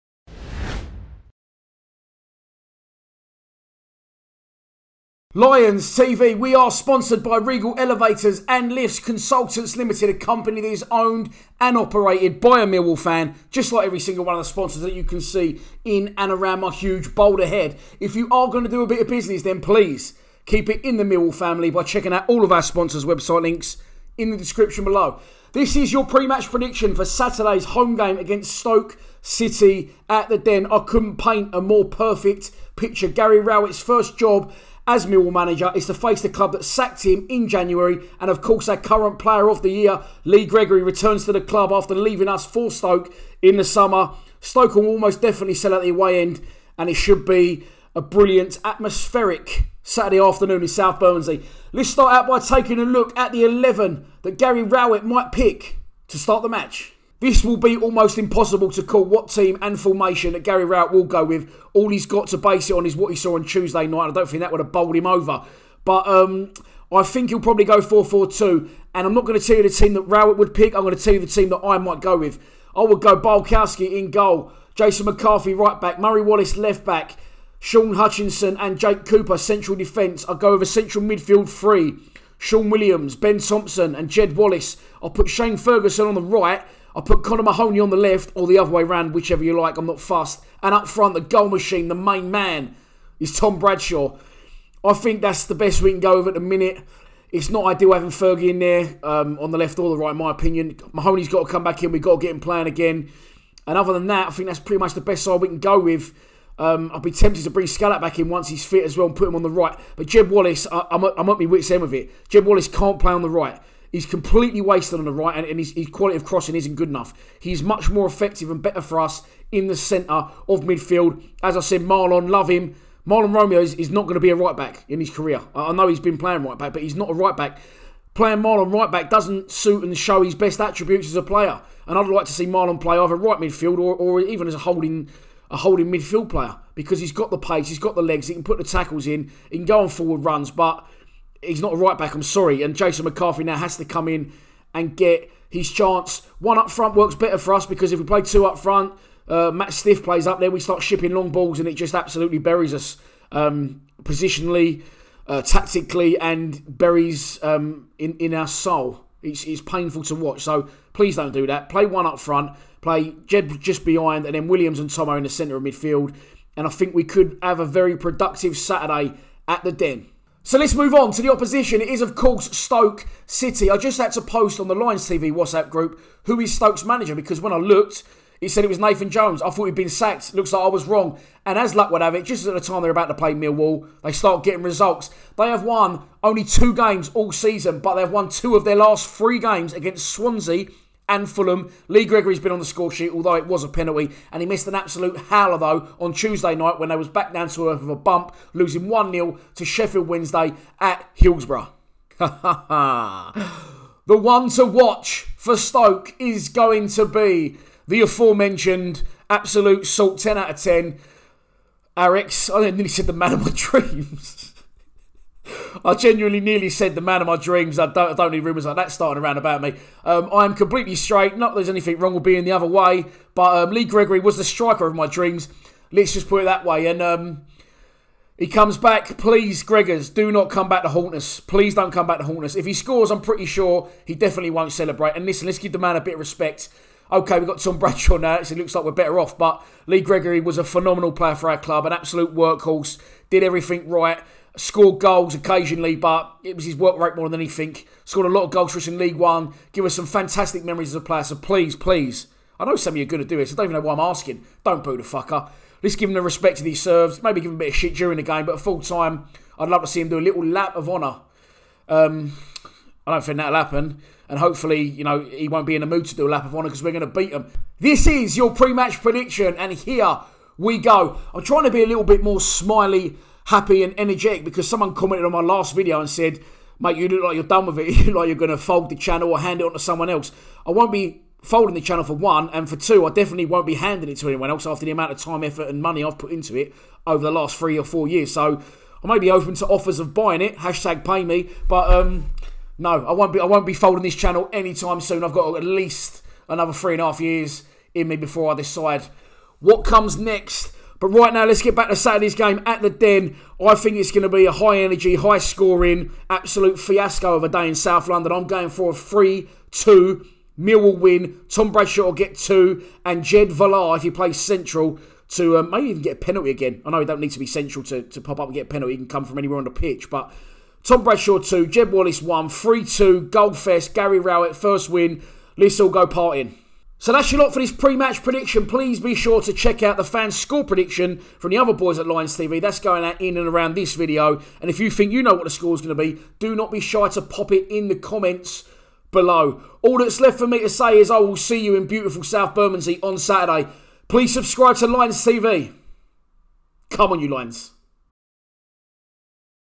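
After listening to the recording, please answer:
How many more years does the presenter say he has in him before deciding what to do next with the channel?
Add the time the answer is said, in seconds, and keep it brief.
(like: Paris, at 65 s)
3 and a half, at 296 s.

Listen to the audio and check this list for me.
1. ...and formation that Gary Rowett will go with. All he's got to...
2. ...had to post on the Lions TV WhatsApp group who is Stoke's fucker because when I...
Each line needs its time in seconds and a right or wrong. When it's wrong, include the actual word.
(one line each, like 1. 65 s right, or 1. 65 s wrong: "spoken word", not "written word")
1. 59 s right
2. 173 s wrong: "manager", not "fucker".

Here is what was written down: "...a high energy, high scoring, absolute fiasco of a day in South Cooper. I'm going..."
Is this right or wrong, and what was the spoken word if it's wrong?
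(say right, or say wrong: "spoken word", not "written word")
wrong: "London", not "Cooper".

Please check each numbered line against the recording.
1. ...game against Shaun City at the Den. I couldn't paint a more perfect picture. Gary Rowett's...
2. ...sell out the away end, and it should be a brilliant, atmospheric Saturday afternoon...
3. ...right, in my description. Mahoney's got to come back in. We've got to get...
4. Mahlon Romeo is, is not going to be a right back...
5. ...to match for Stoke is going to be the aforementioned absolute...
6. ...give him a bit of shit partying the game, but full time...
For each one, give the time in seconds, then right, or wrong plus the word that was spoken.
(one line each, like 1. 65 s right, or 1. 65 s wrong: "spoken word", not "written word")
1. 27 s wrong: "Stoke", not "Shaun"
2. 45 s right
3. 99 s wrong: "opinion", not "description"
4. 123 s right
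5. 204 s wrong: "watch", not "match"
6. 257 s wrong: "during", not "partying".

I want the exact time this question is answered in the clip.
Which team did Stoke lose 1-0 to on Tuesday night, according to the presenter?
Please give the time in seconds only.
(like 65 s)
199 s.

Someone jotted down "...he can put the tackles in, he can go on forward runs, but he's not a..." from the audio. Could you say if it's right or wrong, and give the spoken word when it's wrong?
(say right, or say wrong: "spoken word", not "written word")
right.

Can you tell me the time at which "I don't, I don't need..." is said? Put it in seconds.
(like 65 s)
217 s.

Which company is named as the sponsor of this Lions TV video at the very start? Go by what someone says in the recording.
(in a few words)
Regal Elevators and Lifts Consultants Limited.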